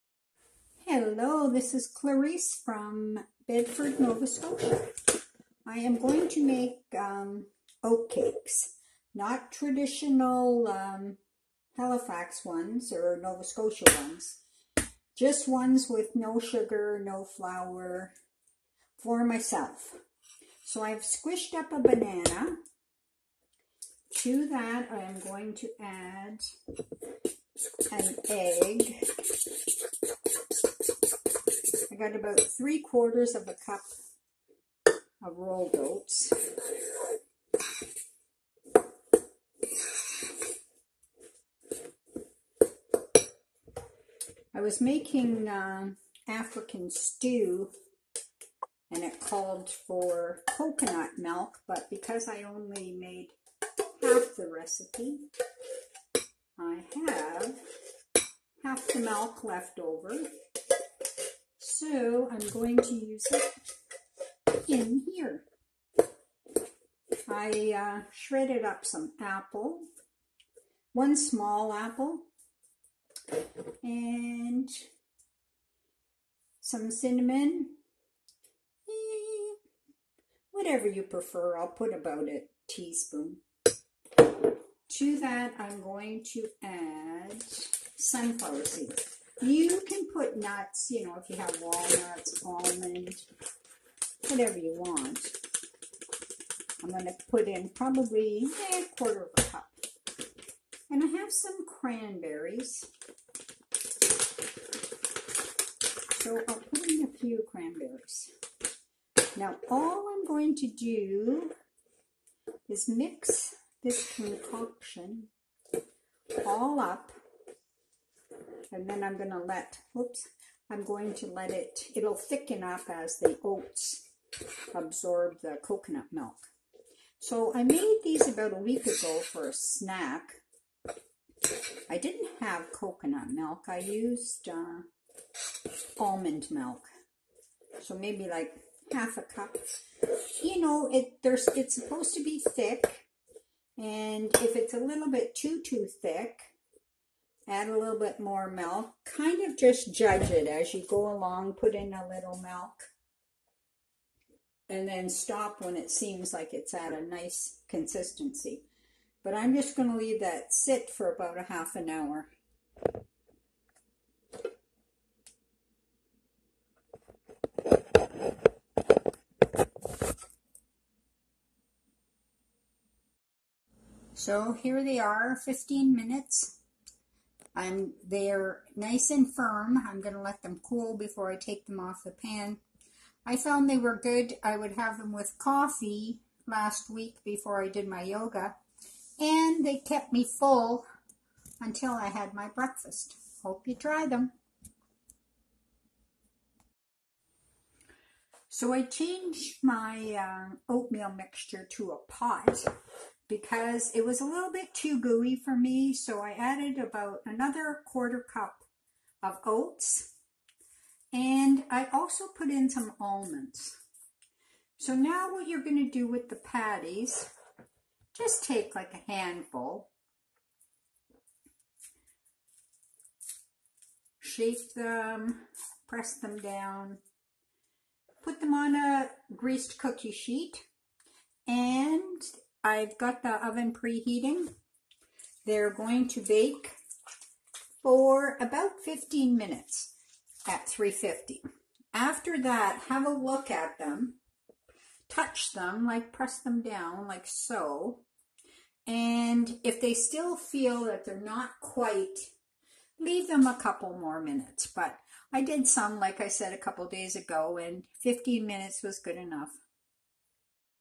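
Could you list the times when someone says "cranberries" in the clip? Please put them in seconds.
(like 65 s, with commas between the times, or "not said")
101 s, 107 s.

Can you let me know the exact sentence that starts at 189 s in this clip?
And they kept me full until I had my breakfast.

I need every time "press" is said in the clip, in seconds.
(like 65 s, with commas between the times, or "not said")
225 s, 246 s.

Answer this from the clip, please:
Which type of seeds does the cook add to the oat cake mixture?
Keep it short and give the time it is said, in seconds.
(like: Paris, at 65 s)
Sunflower seeds, at 87 s.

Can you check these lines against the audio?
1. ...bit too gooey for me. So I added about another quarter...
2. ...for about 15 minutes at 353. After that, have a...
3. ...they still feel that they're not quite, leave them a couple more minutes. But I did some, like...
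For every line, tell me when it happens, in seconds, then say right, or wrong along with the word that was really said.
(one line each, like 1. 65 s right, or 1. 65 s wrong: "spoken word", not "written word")
1. 204 s right
2. 237 s wrong: "350", not "353"
3. 249 s right.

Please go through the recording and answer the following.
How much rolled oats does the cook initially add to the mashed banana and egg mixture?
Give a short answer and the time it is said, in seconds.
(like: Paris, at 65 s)
3/4 cup, at 32 s.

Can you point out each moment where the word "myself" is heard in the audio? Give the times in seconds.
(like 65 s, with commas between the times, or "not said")
19 s.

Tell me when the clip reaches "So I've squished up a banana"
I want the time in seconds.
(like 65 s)
20 s.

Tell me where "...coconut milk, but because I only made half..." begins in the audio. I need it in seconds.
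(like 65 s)
50 s.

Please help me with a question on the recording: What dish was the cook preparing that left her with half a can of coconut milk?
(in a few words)
African stew.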